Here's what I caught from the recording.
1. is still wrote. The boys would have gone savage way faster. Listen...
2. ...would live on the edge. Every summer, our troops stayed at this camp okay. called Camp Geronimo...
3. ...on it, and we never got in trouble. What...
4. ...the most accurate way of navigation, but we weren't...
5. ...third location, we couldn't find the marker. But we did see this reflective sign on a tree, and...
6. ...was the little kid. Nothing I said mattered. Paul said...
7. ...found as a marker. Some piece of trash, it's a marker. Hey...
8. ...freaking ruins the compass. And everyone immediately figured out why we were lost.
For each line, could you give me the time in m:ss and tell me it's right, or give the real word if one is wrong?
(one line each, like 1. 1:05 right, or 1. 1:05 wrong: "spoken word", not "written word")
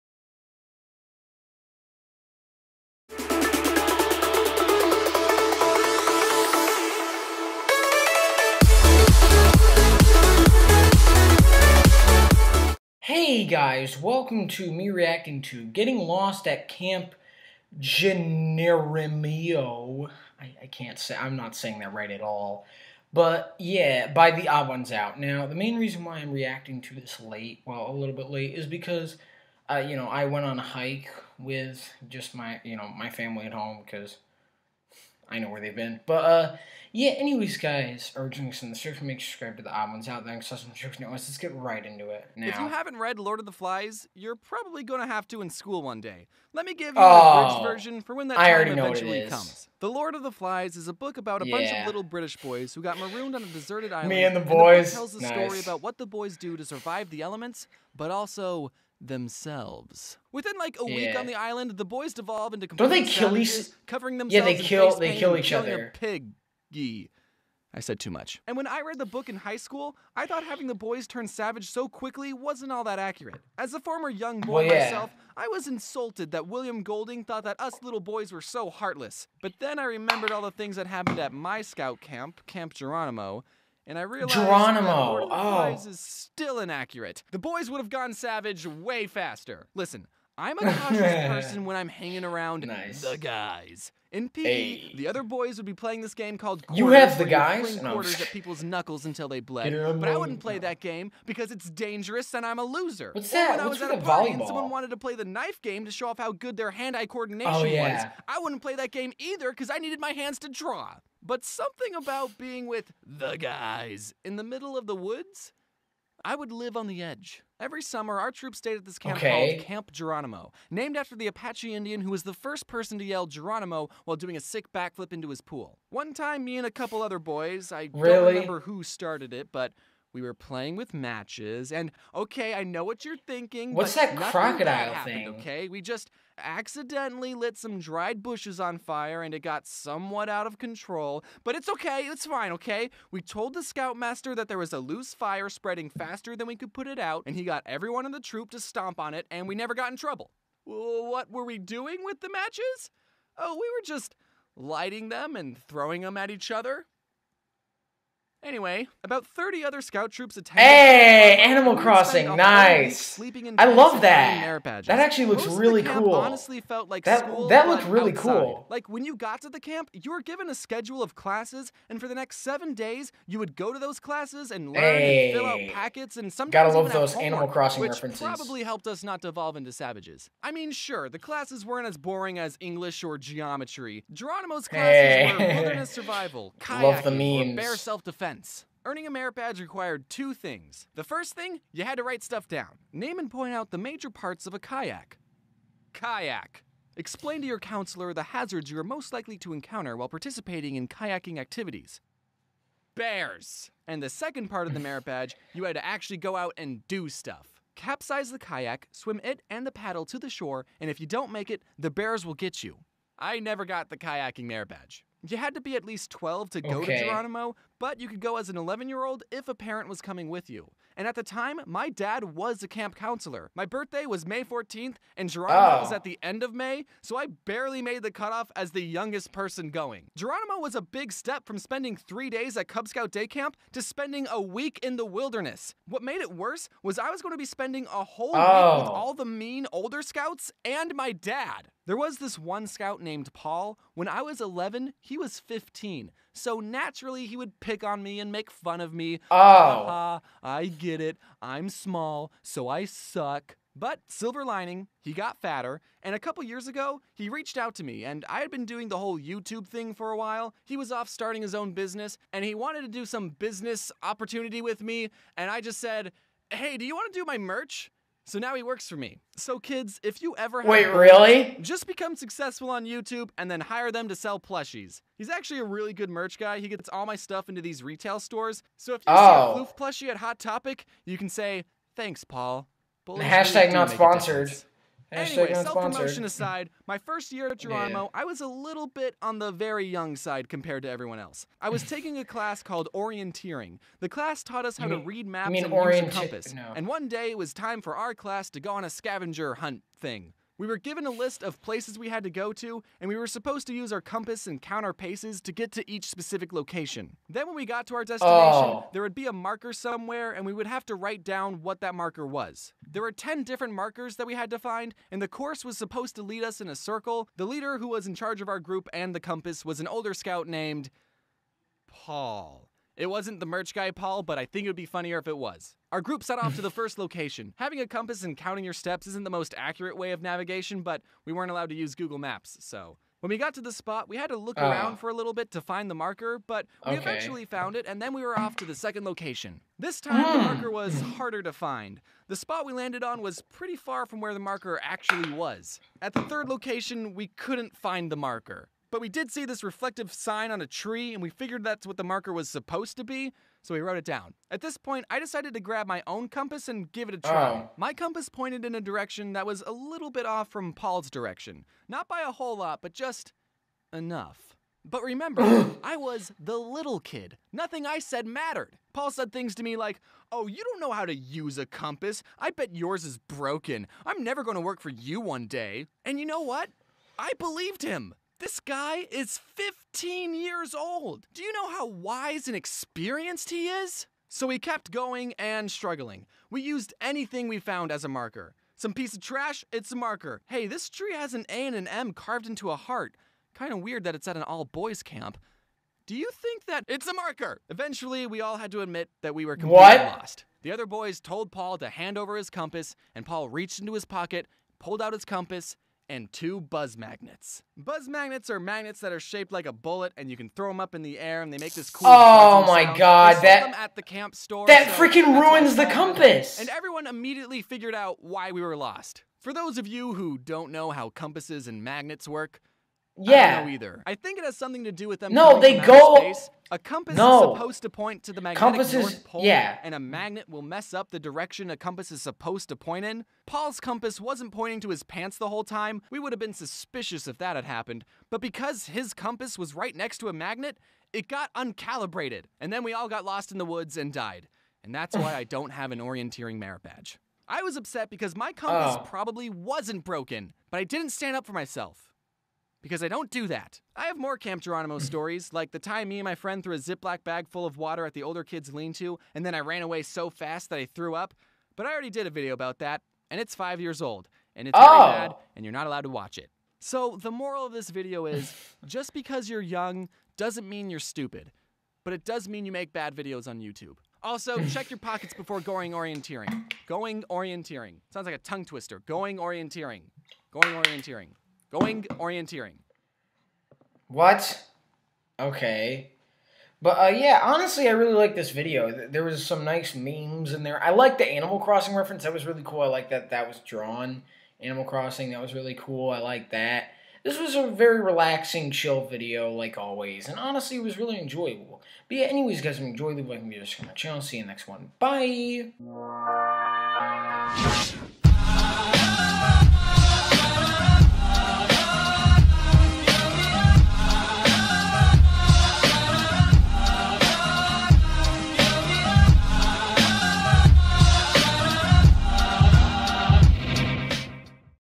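1. 1:25 wrong: "inaccurate", not "wrote"
2. 1:56 right
3. 2:28 right
4. 5:29 right
5. 5:46 right
6. 6:05 right
7. 6:27 right
8. 6:54 right.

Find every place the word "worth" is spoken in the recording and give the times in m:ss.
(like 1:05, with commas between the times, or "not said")
not said.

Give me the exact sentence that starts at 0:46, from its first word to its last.
Let me give you oh, the version for when that I eventually comes.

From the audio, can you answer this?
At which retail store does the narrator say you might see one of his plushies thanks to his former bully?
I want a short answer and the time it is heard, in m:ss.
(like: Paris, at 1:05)
Hot Topic, at 4:40.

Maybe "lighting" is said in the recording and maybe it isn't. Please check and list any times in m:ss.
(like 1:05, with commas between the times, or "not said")
2:34.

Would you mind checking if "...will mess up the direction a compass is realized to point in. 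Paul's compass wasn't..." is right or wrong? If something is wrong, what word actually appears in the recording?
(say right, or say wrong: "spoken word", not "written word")
wrong: "supposed", not "realized".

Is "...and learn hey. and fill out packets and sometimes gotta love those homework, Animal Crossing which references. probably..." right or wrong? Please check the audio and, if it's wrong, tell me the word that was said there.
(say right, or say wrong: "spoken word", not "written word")
right.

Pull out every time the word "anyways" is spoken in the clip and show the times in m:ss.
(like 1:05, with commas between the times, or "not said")
0:37, 2:38, 4:45, 8:22.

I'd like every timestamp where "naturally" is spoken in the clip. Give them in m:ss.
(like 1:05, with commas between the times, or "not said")
4:06.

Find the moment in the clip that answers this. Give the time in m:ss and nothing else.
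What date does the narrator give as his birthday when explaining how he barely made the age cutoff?
3:44.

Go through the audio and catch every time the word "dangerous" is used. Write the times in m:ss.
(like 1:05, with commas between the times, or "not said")
1:41.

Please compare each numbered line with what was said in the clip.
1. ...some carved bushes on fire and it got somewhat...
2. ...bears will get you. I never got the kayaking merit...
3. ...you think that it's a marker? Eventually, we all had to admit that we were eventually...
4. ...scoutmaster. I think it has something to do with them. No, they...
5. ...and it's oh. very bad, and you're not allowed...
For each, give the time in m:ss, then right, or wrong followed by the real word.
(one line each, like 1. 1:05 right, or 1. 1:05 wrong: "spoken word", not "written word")
1. 2:17 wrong: "dried", not "carved"
2. 3:31 right
3. 6:36 wrong: "completely", not "eventually"
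4. 7:03 wrong: "either", not "scoutmaster"
5. 7:44 right.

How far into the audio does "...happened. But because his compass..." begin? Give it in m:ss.
7:17.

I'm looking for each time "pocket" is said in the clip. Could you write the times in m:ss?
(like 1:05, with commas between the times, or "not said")
6:44, 7:54.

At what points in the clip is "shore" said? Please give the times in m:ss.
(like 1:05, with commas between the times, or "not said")
3:30.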